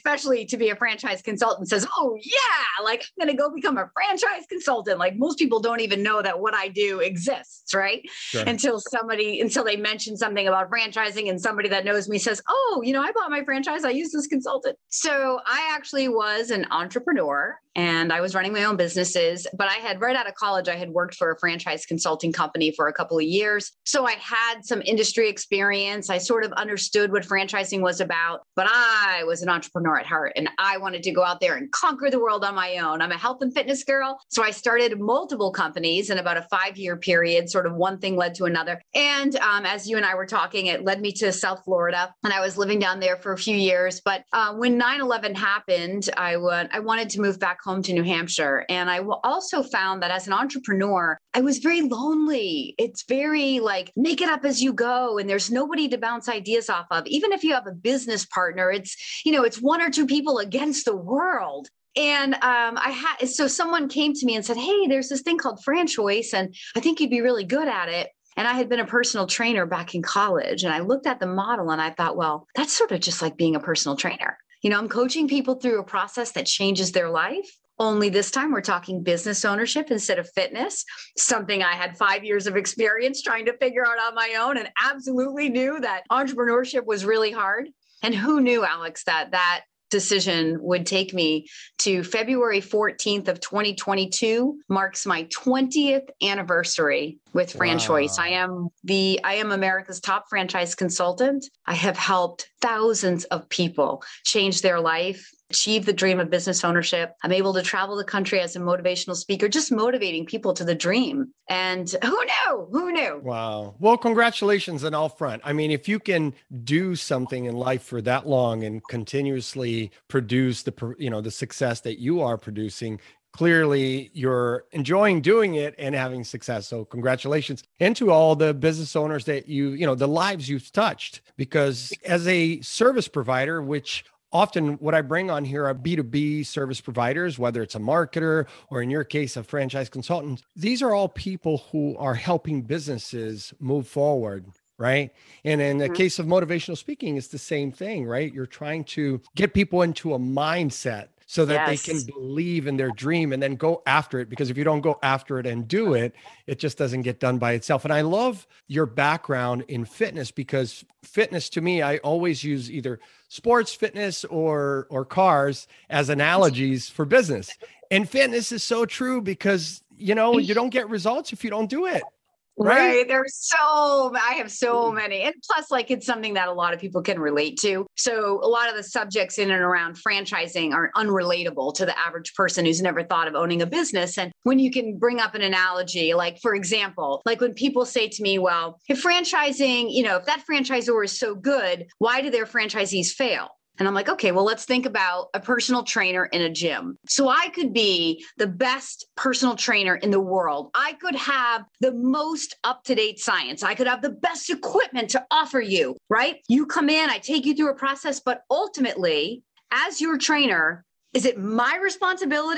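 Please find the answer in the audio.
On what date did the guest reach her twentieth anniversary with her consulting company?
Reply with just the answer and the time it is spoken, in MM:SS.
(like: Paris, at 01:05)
February 14, 2022, at 01:32.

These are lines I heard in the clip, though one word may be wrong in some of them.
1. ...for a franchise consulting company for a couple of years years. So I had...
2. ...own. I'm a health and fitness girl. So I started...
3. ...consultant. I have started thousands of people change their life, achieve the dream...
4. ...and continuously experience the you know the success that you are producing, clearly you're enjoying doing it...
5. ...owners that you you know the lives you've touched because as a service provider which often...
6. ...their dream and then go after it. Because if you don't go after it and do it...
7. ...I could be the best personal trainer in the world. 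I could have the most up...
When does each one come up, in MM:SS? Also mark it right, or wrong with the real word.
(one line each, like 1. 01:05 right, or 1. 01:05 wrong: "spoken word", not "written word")
1. 00:21 right
2. 00:32 right
3. 01:40 wrong: "helped", not "started"
4. 01:58 wrong: "produce", not "experience"
5. 02:08 right
6. 02:32 right
7. 03:17 right.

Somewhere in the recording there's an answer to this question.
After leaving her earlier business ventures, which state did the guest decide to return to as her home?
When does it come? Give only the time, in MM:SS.
00:47.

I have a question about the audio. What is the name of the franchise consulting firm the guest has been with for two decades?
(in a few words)
FranChoice.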